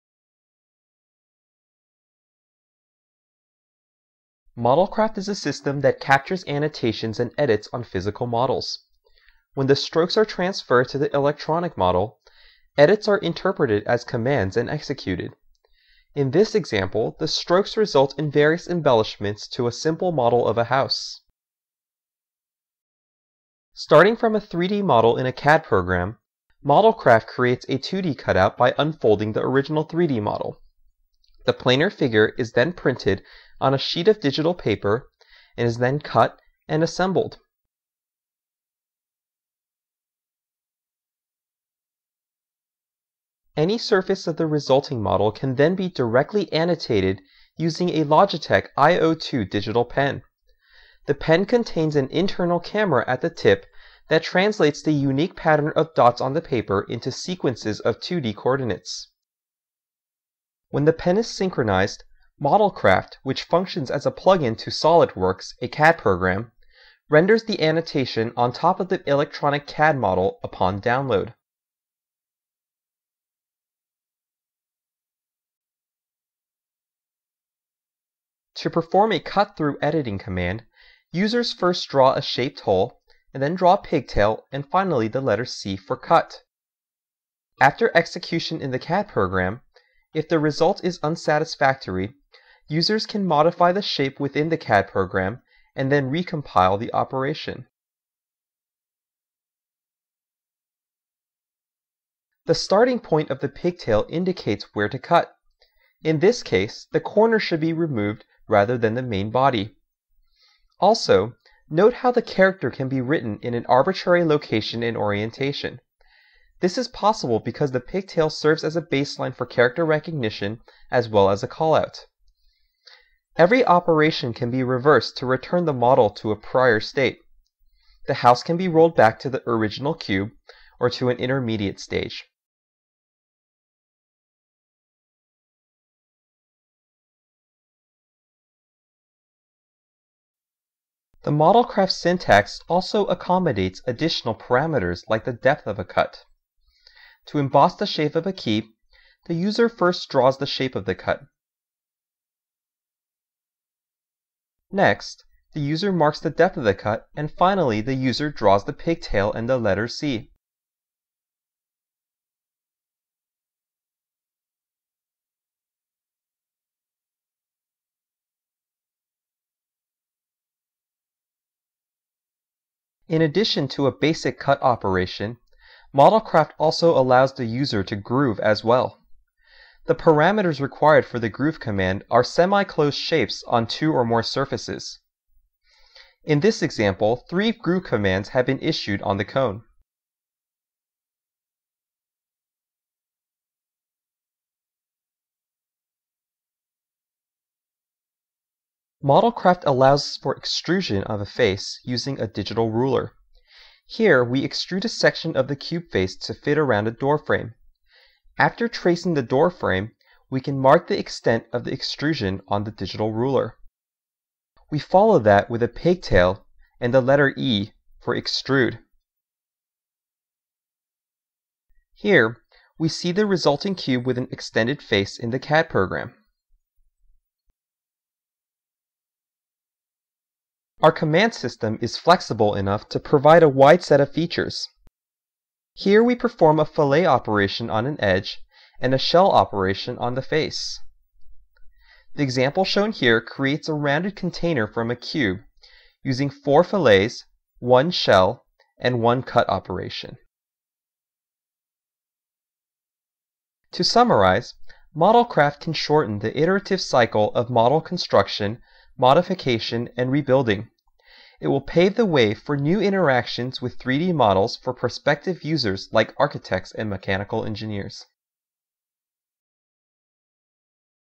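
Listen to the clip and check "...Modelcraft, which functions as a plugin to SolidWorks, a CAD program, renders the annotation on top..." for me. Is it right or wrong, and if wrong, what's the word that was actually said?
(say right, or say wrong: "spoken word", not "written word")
right.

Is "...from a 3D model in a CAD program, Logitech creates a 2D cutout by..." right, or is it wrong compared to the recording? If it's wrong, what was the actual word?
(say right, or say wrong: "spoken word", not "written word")
wrong: "Modelcraft", not "Logitech".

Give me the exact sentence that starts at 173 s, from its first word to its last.
In addition to a basic cut operation, Modelcraft also allows the user to groove as well.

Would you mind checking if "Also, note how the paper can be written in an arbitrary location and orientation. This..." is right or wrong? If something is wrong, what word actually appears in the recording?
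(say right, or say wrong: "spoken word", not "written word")
wrong: "character", not "paper".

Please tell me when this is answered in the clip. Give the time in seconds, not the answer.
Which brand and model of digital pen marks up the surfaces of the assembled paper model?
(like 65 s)
48 s.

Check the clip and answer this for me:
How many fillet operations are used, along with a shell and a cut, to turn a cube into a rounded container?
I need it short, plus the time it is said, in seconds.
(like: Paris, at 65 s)
4, at 246 s.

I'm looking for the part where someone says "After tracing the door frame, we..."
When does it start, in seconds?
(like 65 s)
208 s.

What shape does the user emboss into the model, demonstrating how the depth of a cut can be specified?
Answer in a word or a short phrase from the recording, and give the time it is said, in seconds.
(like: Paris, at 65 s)
a key, at 148 s.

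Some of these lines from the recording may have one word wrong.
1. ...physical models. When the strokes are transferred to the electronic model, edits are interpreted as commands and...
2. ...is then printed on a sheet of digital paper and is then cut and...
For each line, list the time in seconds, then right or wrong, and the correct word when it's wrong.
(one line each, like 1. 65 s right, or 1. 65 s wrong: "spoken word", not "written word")
1. 7 s right
2. 32 s right.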